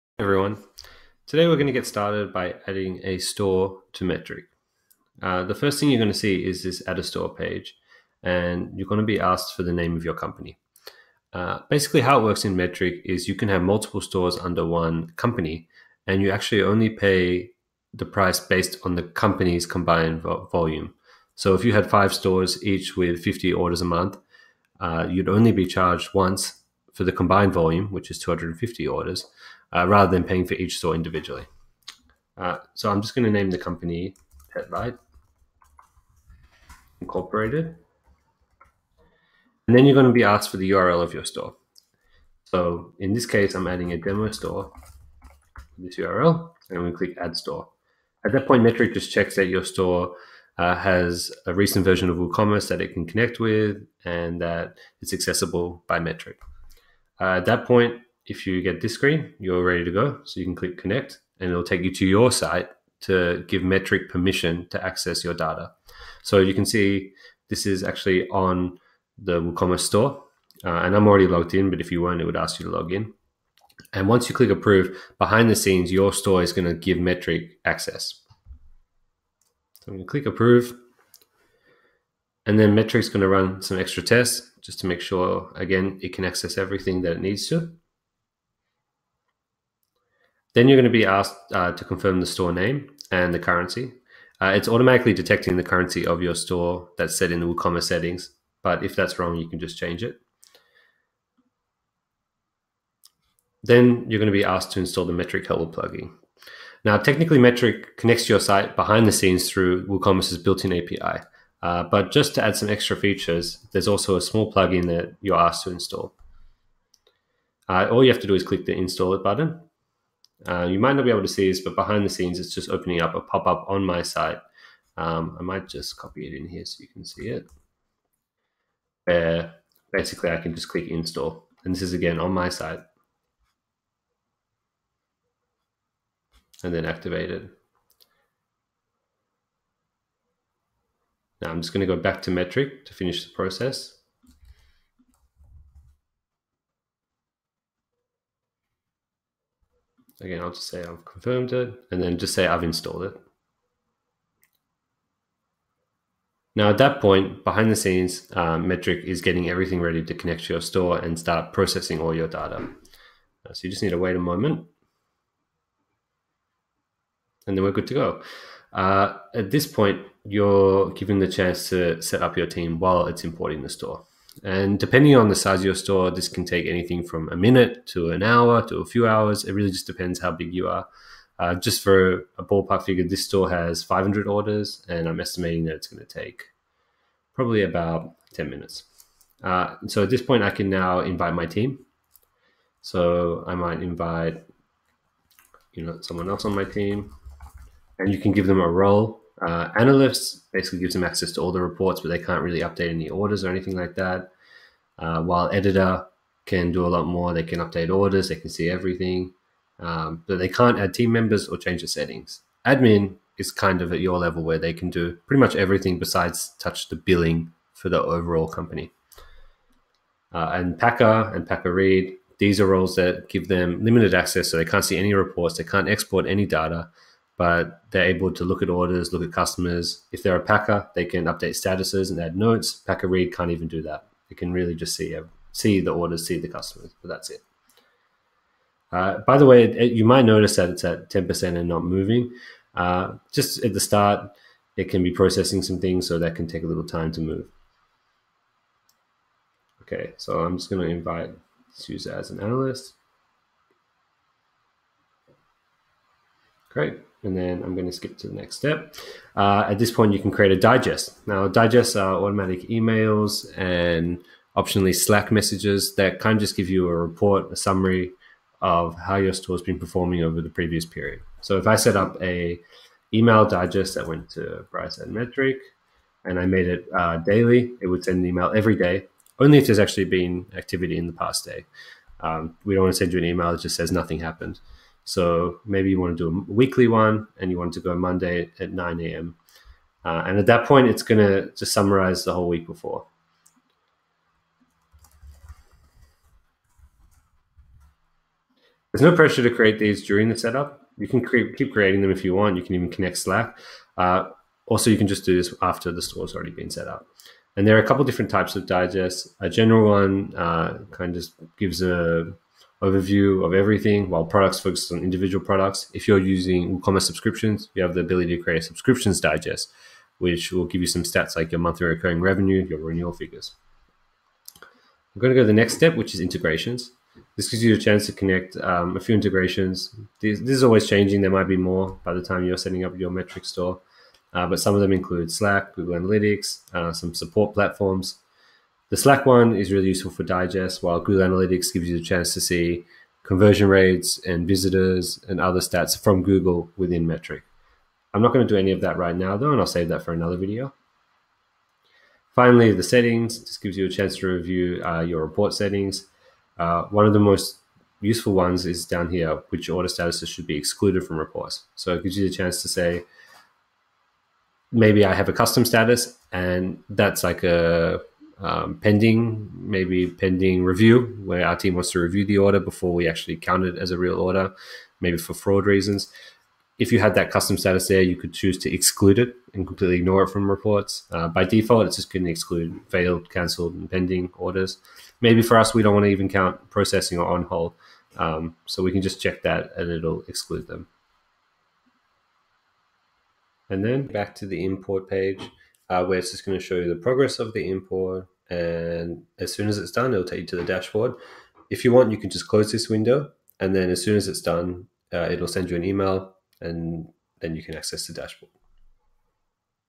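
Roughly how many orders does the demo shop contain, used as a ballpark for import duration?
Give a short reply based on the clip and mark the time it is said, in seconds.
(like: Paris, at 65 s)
500, at 183 s.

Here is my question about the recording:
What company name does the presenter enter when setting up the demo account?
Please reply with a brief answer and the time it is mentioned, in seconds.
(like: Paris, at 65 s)
Petlight Incorporated, at 34 s.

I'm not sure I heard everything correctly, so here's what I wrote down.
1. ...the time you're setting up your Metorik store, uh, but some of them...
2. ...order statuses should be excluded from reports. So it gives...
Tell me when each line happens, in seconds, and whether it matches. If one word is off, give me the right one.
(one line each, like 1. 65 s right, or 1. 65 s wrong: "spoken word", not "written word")
1. 332 s right
2. 359 s right.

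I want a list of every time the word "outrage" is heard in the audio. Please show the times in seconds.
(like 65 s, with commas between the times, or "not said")
not said.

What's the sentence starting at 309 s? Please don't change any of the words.
A general one uh, kind of just gives a overview of everything while products focus on individual products.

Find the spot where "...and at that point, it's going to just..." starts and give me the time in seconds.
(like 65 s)
290 s.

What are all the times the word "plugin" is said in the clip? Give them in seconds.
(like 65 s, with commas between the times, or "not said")
105 s, 114 s.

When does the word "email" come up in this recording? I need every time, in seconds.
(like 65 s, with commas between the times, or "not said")
262 s, 273 s, 278 s, 283 s, 405 s.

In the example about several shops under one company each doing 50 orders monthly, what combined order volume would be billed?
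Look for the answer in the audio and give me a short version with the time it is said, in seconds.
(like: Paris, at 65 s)
250 orders, at 28 s.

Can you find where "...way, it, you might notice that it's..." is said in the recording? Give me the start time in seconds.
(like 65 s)
239 s.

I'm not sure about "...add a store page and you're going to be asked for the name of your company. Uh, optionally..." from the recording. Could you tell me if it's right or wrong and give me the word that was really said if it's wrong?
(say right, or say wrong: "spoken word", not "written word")
wrong: "basically", not "optionally".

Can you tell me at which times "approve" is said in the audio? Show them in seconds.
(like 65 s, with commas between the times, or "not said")
74 s, 80 s.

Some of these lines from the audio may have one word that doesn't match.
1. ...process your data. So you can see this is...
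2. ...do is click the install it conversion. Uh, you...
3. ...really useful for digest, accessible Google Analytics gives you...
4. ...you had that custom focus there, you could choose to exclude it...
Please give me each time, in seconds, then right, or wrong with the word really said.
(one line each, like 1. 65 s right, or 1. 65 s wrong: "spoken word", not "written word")
1. 64 s wrong: "access", not "process"
2. 118 s wrong: "button", not "conversion"
3. 339 s wrong: "while", not "accessible"
4. 376 s wrong: "status", not "focus".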